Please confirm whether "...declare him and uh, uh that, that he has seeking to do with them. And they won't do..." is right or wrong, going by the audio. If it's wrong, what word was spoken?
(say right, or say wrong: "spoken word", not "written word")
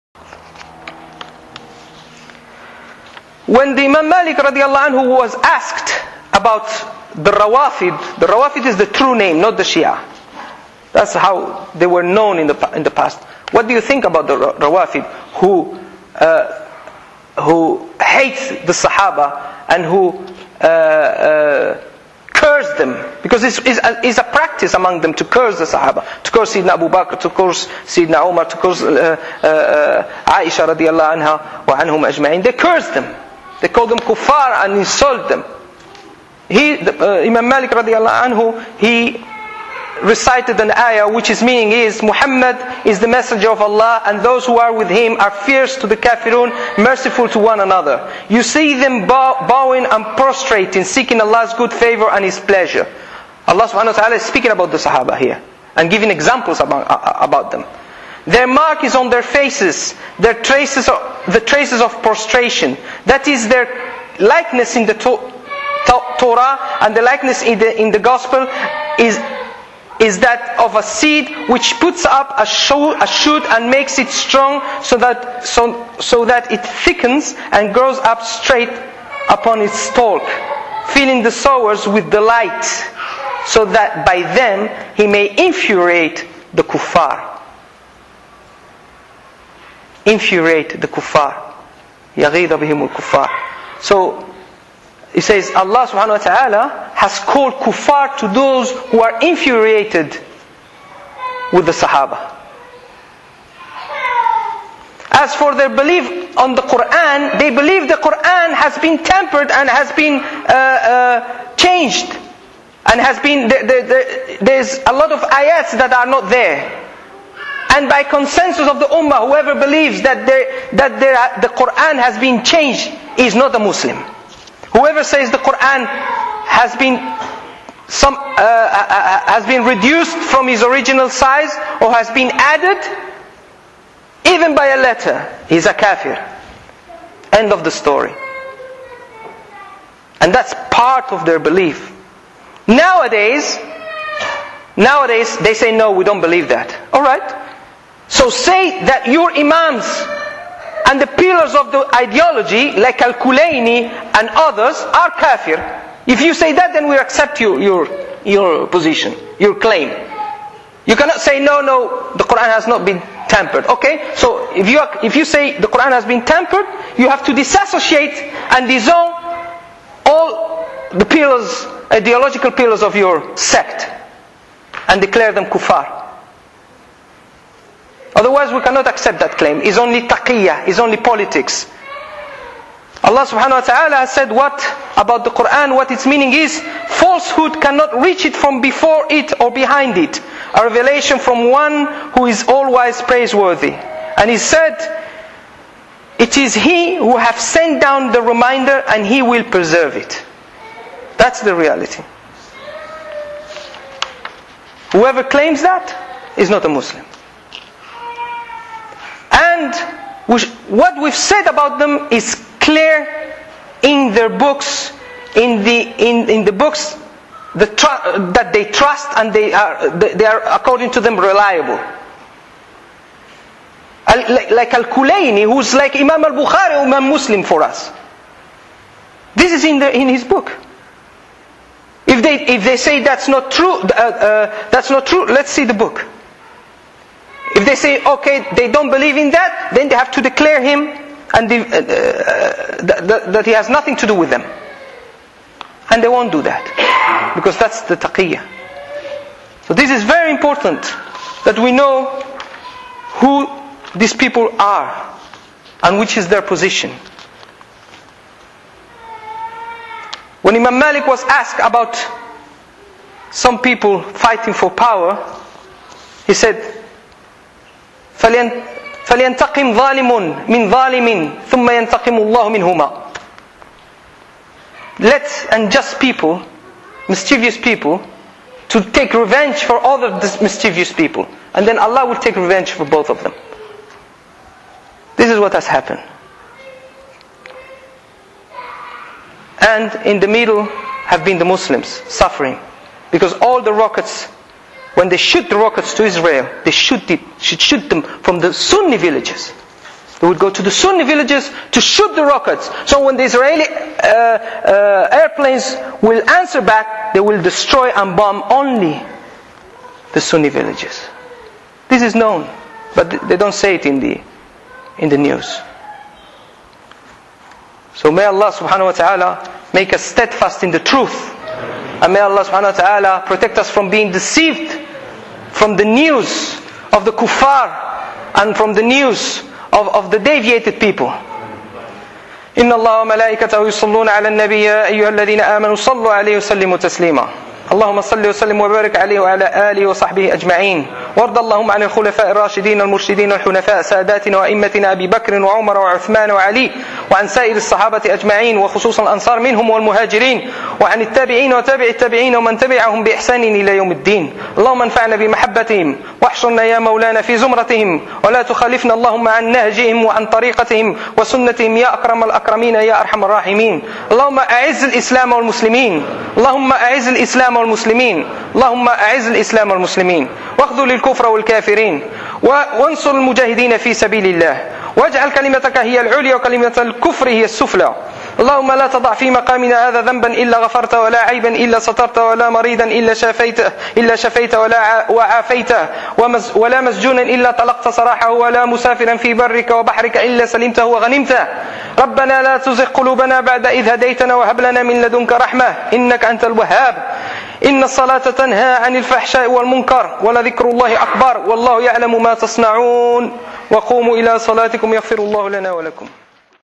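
wrong: "nothing", not "seeking".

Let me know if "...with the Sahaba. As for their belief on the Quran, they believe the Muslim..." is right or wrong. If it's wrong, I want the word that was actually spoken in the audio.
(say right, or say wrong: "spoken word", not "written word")
wrong: "Quran", not "Muslim".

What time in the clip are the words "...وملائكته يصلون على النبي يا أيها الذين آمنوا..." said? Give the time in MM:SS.
05:33.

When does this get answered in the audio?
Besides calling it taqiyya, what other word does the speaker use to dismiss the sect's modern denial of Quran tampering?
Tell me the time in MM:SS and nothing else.
03:00.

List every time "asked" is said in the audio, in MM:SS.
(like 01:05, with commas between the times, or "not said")
00:05, 04:21.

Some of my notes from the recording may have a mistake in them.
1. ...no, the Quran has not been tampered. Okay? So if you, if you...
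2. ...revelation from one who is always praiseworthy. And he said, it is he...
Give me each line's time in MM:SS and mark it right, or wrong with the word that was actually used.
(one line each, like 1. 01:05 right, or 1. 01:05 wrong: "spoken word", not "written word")
1. 02:41 right
2. 03:10 right.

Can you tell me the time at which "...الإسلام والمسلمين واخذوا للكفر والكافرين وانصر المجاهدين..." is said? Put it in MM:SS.
06:09.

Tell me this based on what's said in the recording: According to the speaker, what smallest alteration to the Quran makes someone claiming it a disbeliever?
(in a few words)
a letter.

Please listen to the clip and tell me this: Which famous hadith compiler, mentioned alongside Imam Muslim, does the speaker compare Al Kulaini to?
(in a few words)
Imam Al Bukhari.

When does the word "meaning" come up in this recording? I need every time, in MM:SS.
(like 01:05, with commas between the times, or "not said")
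00:41, 03:06.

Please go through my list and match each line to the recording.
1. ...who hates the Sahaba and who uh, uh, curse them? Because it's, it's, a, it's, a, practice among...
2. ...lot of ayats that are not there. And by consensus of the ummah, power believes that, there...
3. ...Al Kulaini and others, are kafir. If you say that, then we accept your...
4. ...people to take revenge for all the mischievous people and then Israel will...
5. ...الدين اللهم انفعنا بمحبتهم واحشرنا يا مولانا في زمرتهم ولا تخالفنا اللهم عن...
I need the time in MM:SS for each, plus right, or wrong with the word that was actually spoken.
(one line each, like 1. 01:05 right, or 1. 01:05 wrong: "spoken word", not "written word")
1. 00:17 right
2. 01:54 wrong: "whoever", not "power"
3. 02:33 right
4. 04:37 wrong: "Allah", not "Israel"
5. 05:53 right.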